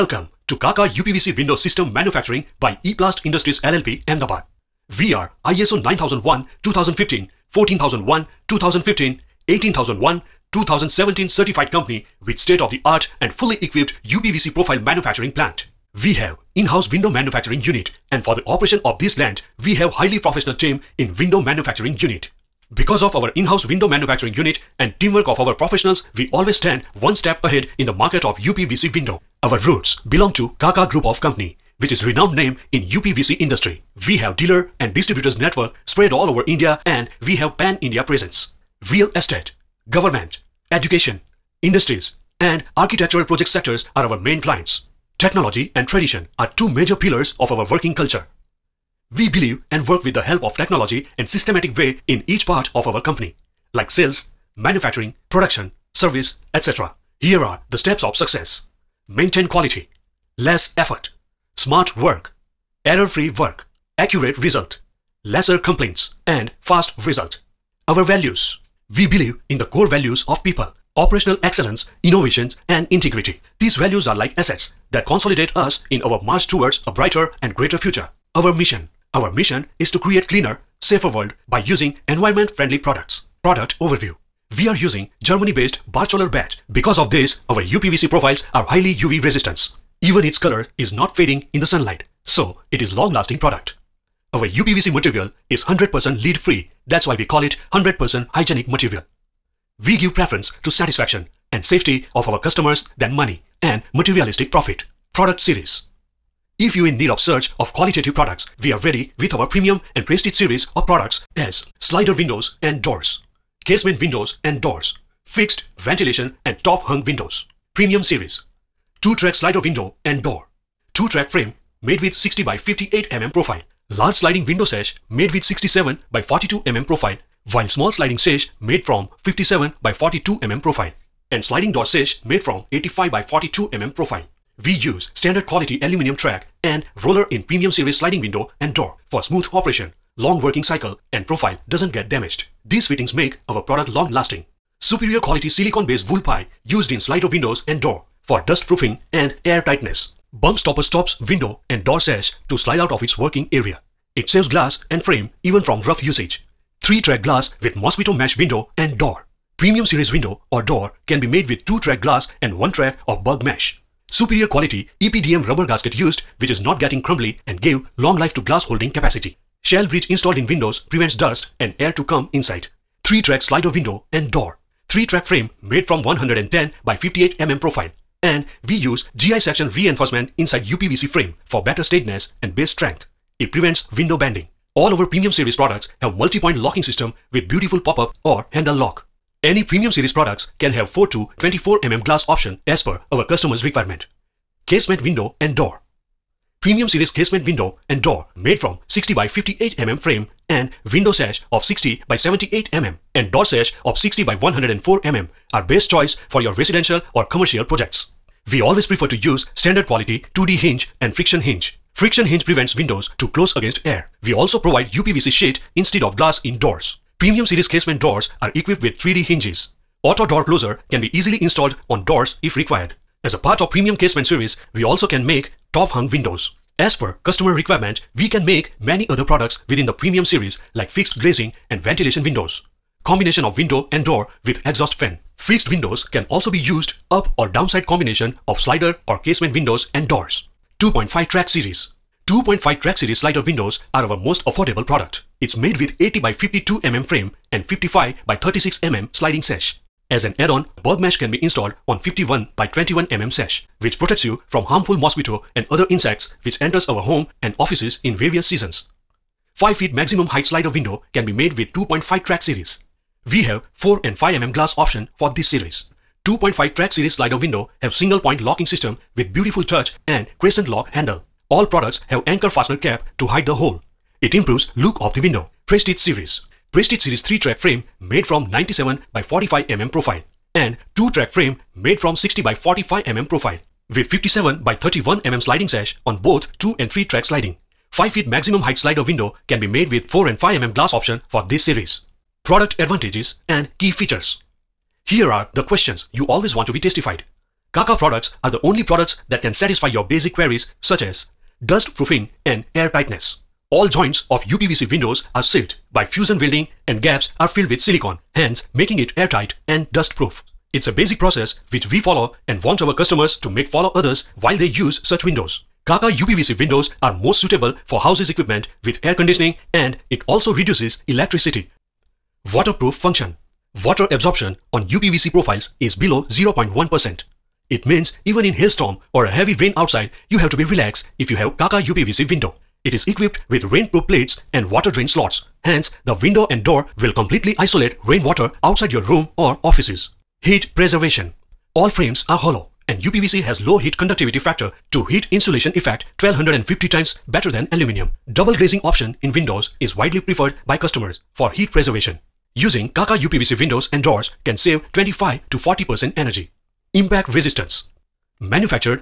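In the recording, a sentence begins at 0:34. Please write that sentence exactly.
We have dealer and distributors network spread all over India and we have pan-India presence.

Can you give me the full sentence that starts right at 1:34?
Our UPVC material is 100% lead-free, that's why we call it 100% hygienic material.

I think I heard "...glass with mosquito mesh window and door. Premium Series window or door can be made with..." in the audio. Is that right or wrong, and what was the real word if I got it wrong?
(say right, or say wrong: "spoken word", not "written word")
right.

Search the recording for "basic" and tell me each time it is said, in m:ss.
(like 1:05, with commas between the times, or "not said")
5:00, 5:10.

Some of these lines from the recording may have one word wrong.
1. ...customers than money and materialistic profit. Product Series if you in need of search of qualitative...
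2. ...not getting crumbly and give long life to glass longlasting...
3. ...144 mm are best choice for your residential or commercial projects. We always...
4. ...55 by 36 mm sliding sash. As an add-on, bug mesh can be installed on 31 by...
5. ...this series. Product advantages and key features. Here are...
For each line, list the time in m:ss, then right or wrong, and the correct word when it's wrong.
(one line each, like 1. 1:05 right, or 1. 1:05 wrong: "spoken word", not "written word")
1. 1:42 right
2. 2:46 wrong: "holding", not "longlasting"
3. 3:24 wrong: "104", not "144"
4. 4:07 wrong: "51", not "31"
5. 4:51 right.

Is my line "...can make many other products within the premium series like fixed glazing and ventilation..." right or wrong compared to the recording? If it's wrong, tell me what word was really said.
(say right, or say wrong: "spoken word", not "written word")
right.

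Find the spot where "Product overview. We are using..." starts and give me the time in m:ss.
1:23.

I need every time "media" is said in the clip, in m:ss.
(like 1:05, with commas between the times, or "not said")
not said.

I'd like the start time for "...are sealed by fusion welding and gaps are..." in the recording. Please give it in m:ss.
5:05.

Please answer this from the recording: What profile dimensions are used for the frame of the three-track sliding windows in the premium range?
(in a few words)
110 by 58 mm.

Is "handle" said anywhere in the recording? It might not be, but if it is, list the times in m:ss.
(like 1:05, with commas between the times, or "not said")
3:08, 4:30.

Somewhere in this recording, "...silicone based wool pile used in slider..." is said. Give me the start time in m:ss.
2:25.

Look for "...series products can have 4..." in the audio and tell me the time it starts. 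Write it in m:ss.
3:09.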